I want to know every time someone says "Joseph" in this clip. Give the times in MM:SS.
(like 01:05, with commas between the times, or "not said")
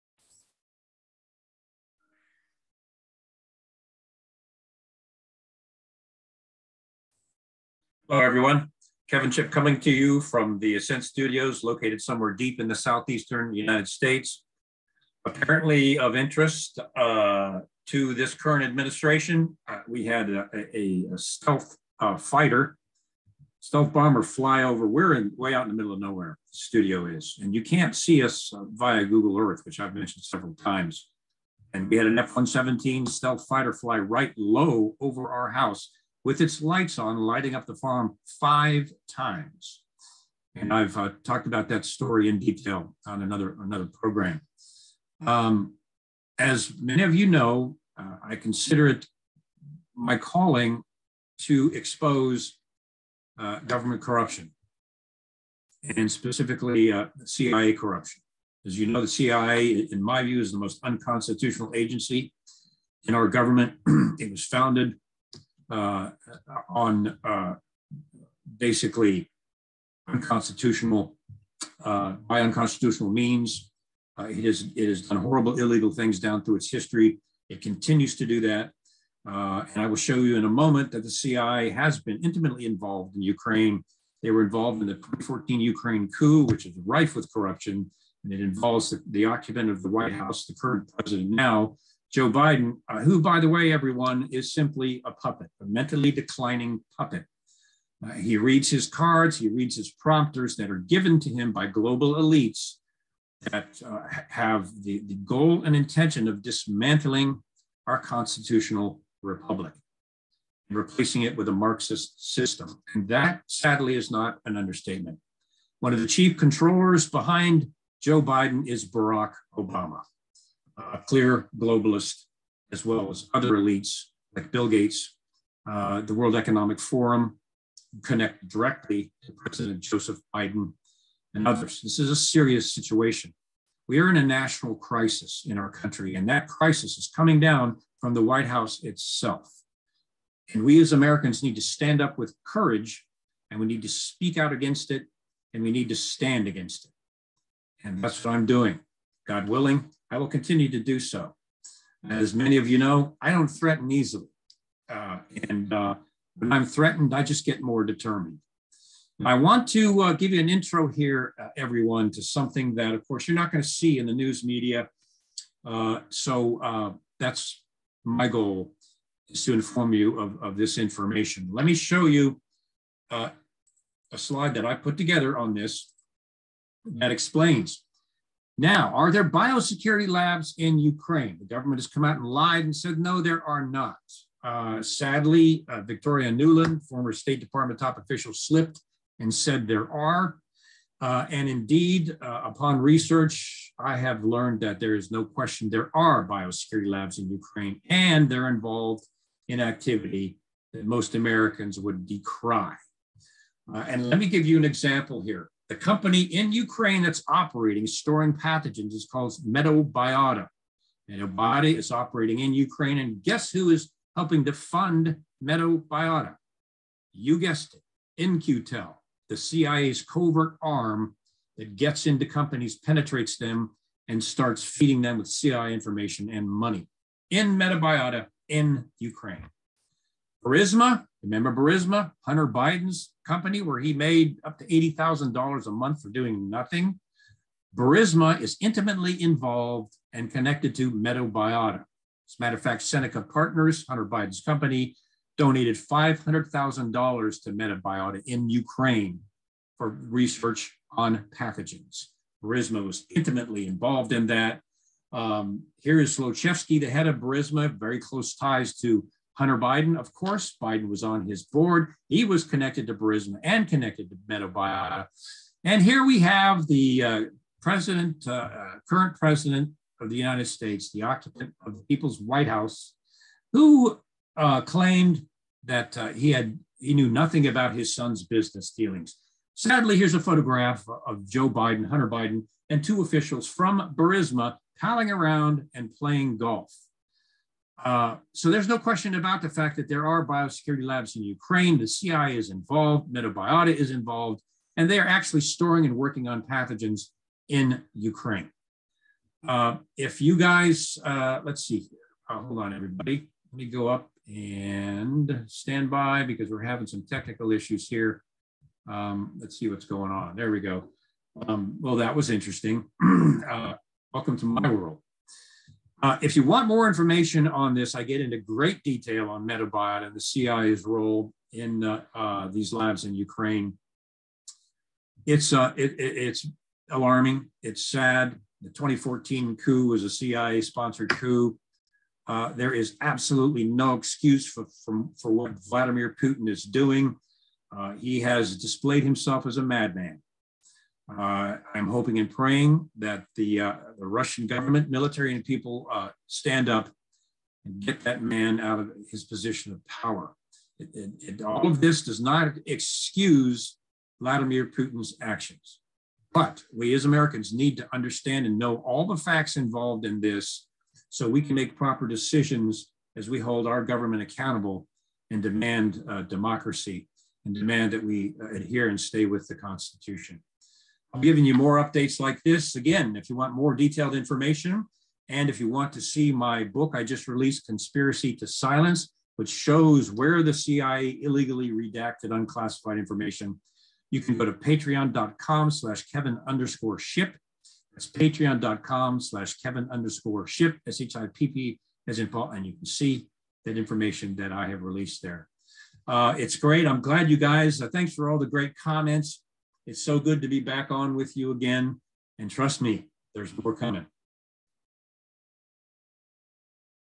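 02:09.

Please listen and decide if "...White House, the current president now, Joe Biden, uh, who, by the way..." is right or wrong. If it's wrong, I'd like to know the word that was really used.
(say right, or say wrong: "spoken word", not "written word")
right.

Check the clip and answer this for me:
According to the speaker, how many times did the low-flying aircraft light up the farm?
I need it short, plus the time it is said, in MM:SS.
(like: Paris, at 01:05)
5, at 00:38.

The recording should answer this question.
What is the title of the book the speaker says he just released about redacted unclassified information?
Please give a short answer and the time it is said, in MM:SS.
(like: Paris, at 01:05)
Conspiracy to Silence, at 06:17.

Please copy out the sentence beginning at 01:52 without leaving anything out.
And that, sadly, is not an understatement.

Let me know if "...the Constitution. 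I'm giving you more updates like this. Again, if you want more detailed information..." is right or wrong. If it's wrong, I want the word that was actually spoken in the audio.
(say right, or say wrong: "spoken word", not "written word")
right.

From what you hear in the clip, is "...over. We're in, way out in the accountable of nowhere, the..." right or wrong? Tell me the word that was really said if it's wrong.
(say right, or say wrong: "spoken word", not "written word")
wrong: "middle", not "accountable".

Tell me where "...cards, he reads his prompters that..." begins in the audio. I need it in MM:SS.
01:38.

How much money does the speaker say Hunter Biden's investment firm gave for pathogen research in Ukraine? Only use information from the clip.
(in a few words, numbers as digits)
$500,000.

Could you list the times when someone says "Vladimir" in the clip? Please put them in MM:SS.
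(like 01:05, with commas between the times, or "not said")
05:35, 05:54.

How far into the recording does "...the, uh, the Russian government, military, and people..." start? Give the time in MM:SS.
05:43.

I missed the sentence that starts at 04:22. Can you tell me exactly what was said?
He was connected to Burisma and connected to Metabiota.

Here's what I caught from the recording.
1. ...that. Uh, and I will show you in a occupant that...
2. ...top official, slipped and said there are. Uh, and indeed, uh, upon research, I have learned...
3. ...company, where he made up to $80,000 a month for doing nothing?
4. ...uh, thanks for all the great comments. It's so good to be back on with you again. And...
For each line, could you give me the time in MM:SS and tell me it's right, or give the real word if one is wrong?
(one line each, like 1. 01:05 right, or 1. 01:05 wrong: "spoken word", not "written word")
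1. 01:18 wrong: "moment", not "occupant"
2. 03:07 right
3. 03:53 right
4. 06:37 right.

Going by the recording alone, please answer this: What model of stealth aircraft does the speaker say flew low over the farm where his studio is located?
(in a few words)
F-117.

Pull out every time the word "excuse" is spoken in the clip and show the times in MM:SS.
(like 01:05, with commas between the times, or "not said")
05:33, 05:52.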